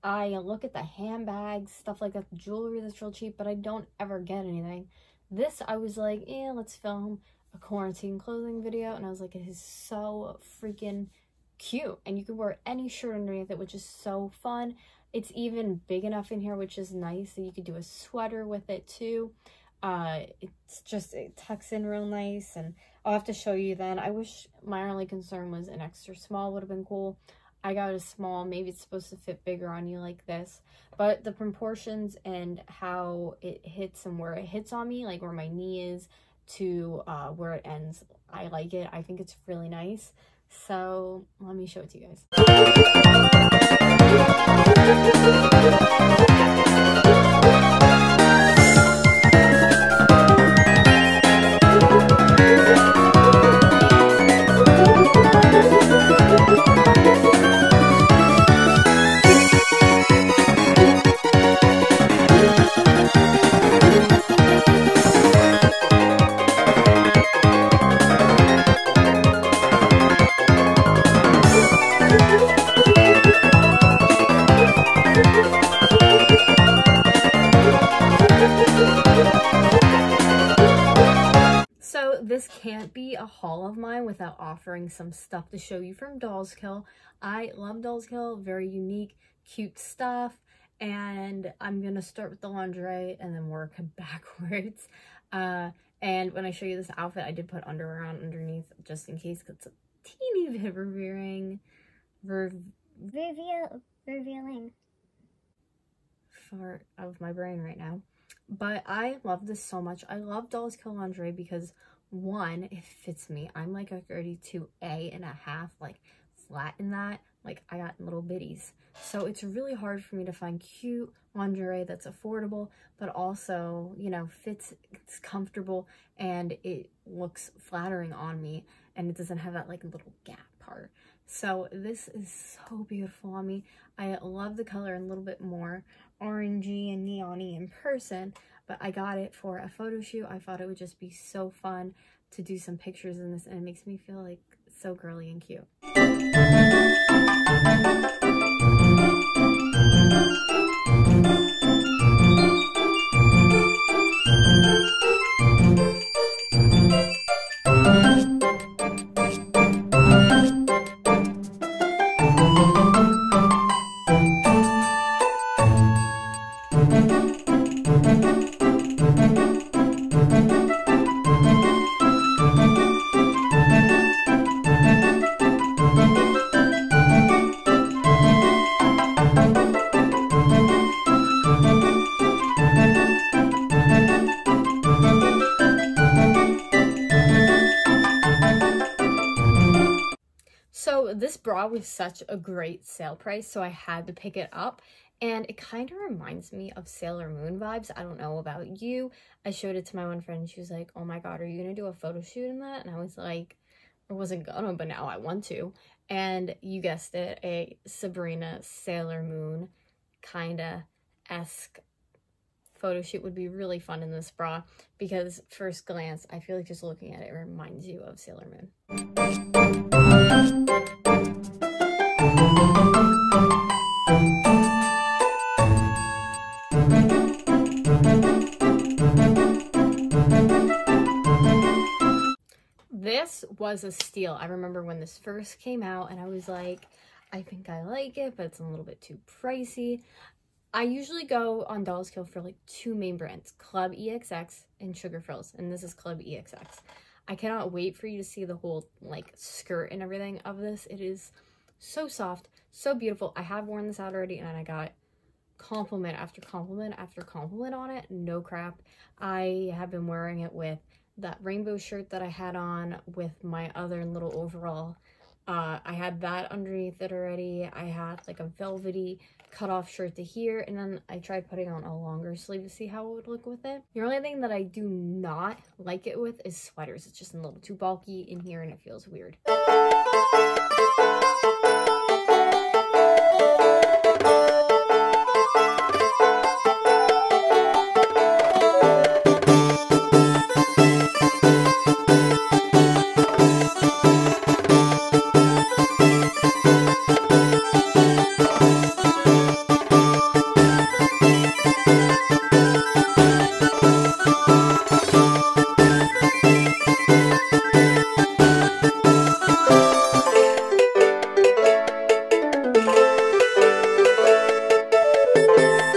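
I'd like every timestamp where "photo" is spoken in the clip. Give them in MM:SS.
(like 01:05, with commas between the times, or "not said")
02:19, 03:21, 03:32.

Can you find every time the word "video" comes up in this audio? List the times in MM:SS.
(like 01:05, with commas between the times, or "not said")
00:08.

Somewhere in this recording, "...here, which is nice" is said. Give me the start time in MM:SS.
00:16.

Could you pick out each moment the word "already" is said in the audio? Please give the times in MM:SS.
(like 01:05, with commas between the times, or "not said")
04:14, 04:27.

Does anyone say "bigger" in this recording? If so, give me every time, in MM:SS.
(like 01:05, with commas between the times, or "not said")
00:29.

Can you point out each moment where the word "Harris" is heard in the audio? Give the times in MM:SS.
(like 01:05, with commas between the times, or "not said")
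not said.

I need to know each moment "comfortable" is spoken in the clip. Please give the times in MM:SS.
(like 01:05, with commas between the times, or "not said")
02:05.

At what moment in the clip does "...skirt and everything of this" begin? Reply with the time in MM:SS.
04:09.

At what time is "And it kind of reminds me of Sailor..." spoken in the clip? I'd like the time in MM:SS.
03:15.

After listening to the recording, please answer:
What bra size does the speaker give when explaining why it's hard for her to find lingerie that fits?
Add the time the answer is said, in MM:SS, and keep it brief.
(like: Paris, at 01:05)
32A and a half, at 01:54.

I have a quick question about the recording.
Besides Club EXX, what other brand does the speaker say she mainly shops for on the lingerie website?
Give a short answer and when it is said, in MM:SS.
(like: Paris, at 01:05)
Sugar Thrillz, at 04:04.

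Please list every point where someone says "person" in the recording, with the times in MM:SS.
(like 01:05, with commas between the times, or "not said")
02:17.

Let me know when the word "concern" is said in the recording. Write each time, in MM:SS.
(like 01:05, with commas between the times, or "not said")
00:25.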